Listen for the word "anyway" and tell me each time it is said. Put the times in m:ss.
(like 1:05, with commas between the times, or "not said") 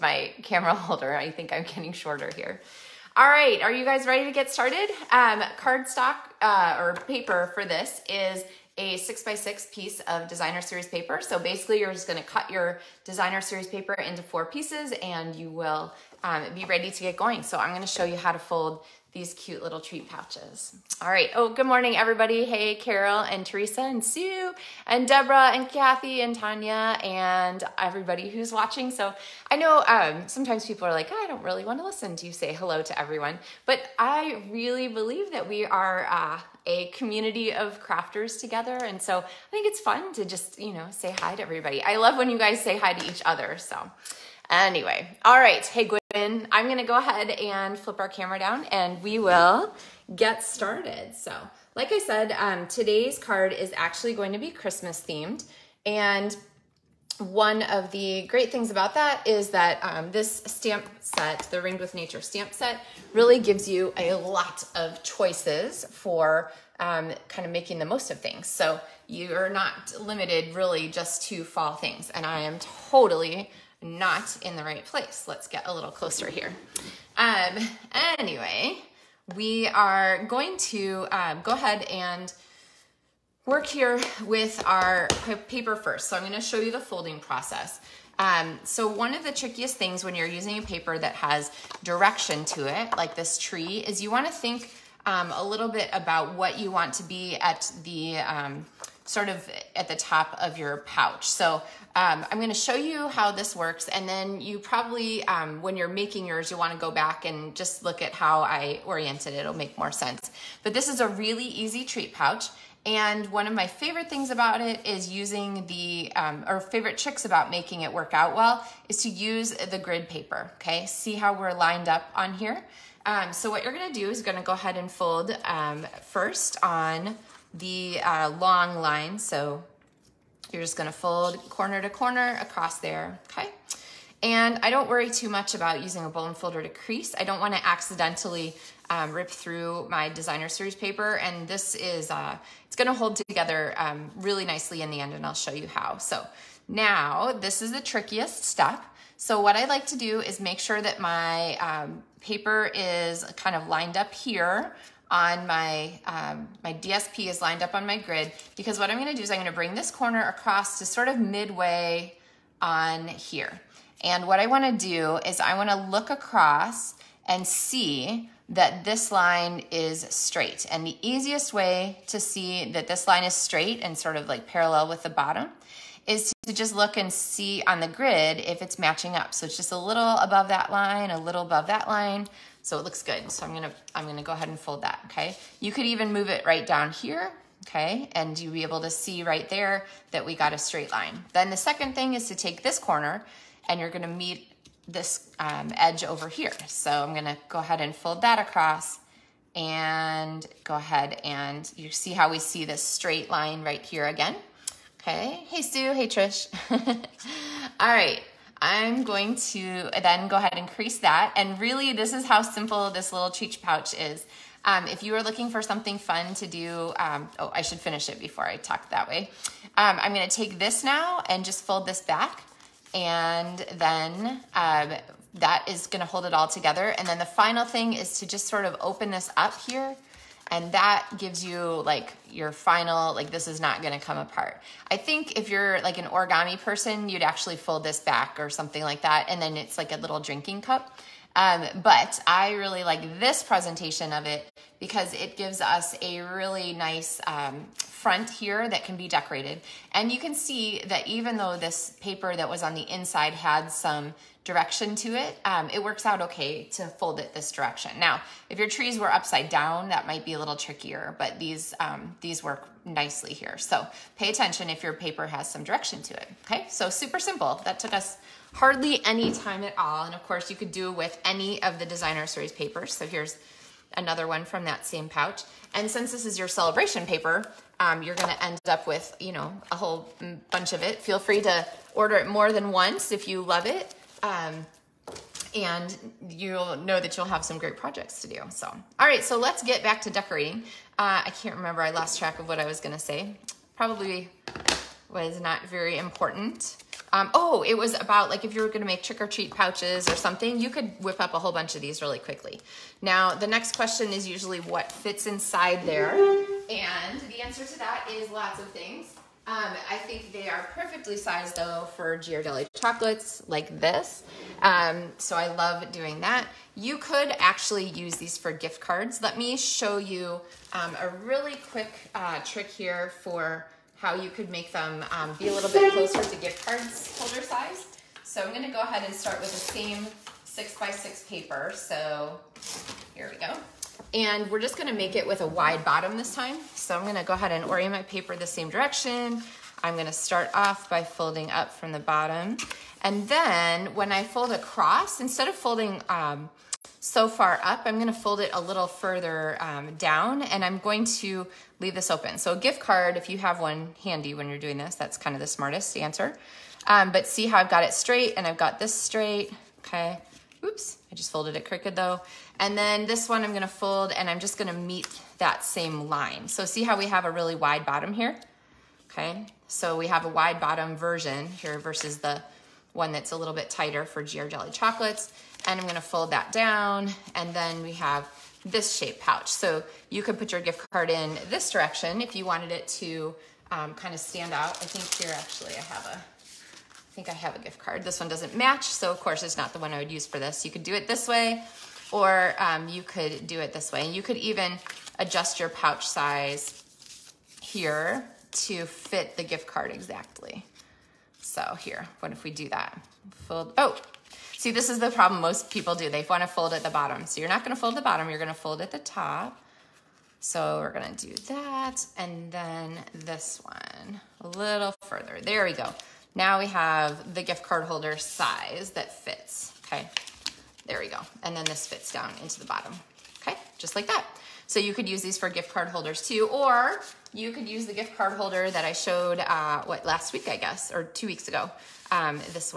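0:44, 1:18.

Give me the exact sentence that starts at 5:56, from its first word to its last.
Um, but see how I've got it straight and I've got this straight, okay?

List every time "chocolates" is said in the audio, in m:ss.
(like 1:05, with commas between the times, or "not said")
5:12, 6:14.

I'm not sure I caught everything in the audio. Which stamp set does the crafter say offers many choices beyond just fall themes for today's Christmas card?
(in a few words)
Ringed with Nature.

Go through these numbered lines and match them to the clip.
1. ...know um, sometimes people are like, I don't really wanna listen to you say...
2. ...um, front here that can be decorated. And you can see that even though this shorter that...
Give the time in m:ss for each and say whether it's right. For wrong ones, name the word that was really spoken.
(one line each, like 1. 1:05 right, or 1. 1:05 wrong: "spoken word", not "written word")
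1. 0:29 right
2. 4:07 wrong: "paper", not "shorter".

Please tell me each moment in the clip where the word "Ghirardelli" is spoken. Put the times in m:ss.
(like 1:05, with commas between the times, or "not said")
5:12, 6:14.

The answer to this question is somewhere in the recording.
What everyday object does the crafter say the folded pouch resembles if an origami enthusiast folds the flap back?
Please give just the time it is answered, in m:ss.
4:00.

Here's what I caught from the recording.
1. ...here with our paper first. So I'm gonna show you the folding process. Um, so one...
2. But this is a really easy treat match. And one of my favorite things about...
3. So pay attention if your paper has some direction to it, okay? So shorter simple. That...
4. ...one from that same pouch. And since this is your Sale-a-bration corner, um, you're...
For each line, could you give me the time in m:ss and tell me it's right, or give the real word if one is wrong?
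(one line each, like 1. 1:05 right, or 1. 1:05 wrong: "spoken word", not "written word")
1. 1:23 right
2. 1:50 wrong: "pouch", not "match"
3. 4:23 wrong: "super", not "shorter"
4. 4:34 wrong: "paper", not "corner".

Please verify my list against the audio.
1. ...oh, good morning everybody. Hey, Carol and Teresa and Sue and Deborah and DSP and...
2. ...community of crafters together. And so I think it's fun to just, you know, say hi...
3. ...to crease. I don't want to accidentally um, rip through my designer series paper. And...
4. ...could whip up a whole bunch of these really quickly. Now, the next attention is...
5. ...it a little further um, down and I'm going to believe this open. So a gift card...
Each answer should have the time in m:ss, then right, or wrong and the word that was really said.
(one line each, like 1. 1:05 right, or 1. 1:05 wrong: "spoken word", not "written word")
1. 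0:21 wrong: "Kathy", not "DSP"
2. 0:36 right
3. 2:16 right
4. 5:00 wrong: "question", not "attention"
5. 5:48 wrong: "leave", not "believe".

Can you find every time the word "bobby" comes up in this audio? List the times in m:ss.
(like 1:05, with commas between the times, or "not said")
not said.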